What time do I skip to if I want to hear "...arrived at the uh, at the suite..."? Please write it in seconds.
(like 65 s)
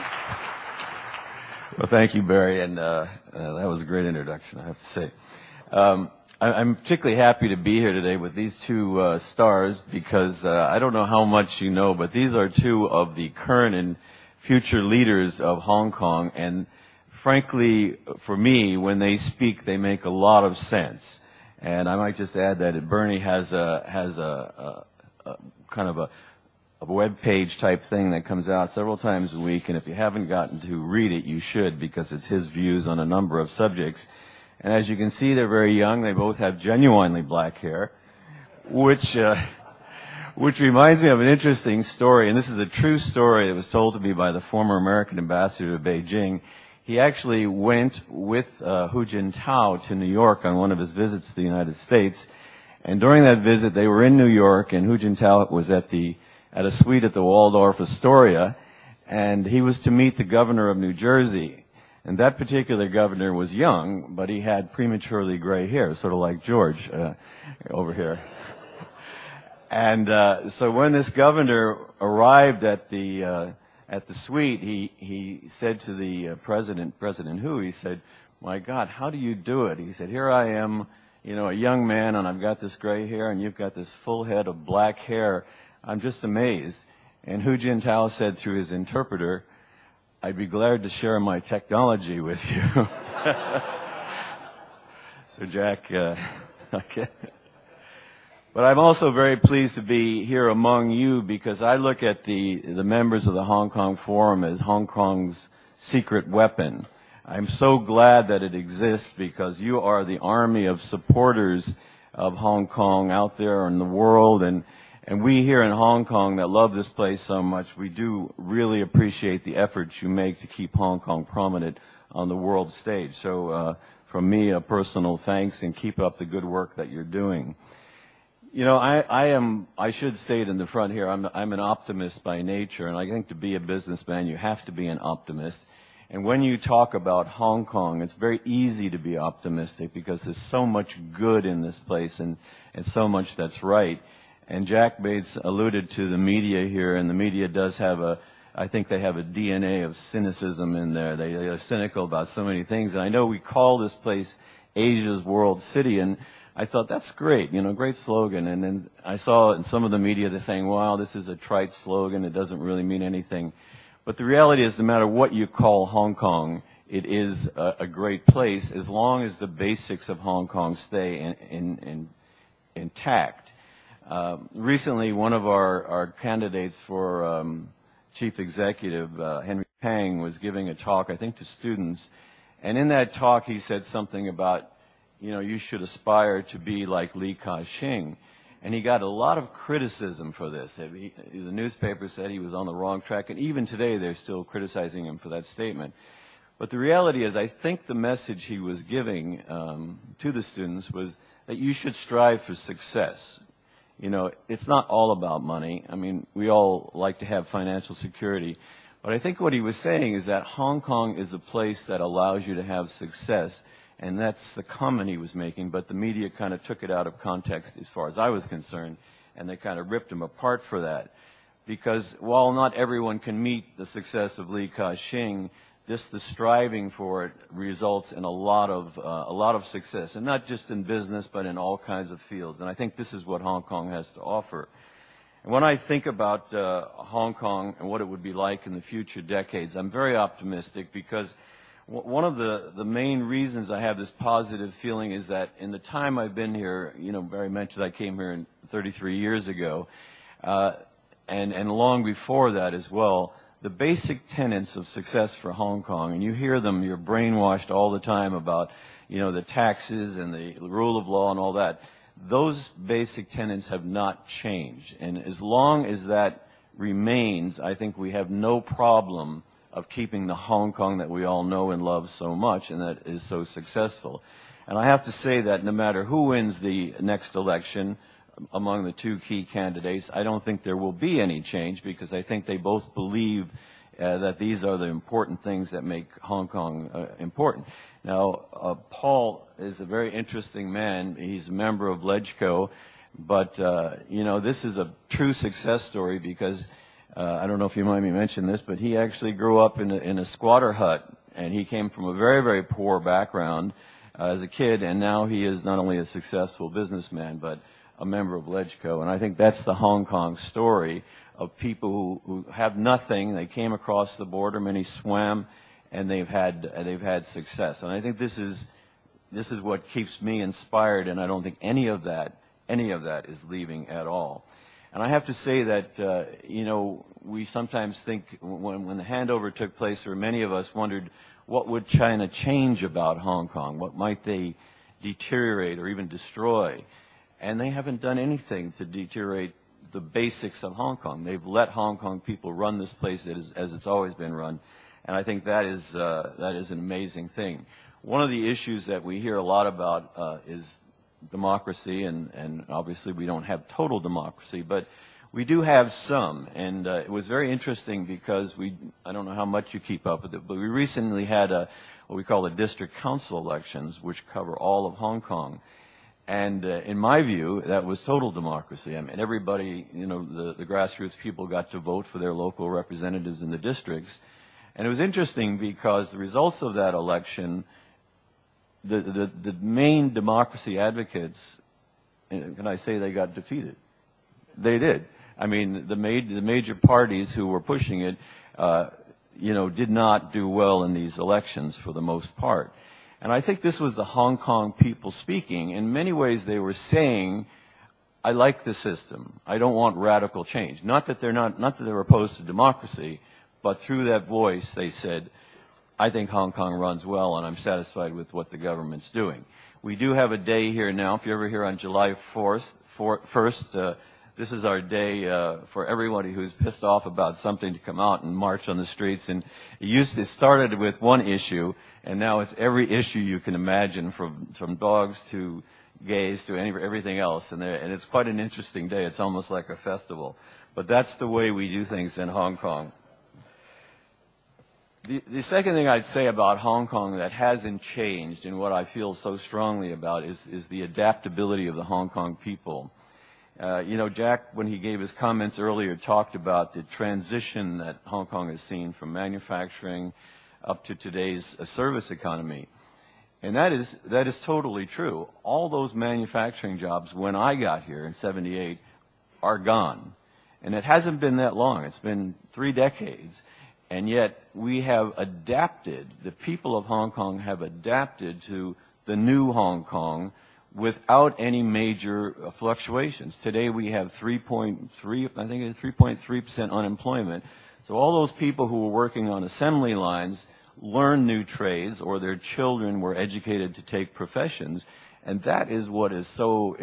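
71 s.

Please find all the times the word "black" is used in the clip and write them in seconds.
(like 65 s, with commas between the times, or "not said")
37 s, 84 s.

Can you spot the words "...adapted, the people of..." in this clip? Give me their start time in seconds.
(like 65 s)
465 s.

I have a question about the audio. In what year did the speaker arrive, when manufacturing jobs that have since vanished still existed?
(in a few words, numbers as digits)
1978.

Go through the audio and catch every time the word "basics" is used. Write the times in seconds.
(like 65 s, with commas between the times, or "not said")
169 s, 253 s, 262 s, 339 s.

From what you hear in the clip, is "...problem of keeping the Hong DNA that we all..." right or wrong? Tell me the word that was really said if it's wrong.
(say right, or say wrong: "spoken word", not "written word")
wrong: "Kong", not "DNA".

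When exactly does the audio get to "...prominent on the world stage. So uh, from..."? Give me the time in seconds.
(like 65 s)
121 s.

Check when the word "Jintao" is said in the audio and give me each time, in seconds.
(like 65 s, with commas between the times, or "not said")
49 s, 54 s, 87 s.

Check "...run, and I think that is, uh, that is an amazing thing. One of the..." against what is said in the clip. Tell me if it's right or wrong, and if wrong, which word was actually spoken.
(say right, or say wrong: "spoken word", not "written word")
right.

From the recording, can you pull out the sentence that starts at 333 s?
What might they deteriorate or even destroy?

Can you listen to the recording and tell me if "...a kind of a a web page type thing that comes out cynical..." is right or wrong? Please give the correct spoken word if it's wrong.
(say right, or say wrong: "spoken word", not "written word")
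wrong: "several", not "cynical".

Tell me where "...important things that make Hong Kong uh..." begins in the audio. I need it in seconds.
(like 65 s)
284 s.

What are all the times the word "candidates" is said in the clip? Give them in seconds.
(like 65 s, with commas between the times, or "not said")
176 s, 279 s.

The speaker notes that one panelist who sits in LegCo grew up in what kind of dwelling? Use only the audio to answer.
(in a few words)
squatter hut.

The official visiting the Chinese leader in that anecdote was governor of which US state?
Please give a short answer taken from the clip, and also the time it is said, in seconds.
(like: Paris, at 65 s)
New Jersey, at 60 s.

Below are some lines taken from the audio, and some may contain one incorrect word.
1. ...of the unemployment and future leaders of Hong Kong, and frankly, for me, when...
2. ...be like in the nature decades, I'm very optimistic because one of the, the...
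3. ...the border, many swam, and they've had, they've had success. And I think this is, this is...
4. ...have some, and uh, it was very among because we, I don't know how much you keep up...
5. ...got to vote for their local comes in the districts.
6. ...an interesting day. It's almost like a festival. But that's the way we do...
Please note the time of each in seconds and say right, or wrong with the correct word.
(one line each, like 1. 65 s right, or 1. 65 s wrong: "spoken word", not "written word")
1. 12 s wrong: "current", not "unemployment"
2. 238 s wrong: "future", not "nature"
3. 314 s right
4. 355 s wrong: "interesting", not "among"
5. 371 s wrong: "representatives", not "comes"
6. 428 s right.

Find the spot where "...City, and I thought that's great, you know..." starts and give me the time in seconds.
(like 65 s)
155 s.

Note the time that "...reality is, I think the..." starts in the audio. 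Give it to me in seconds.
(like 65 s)
196 s.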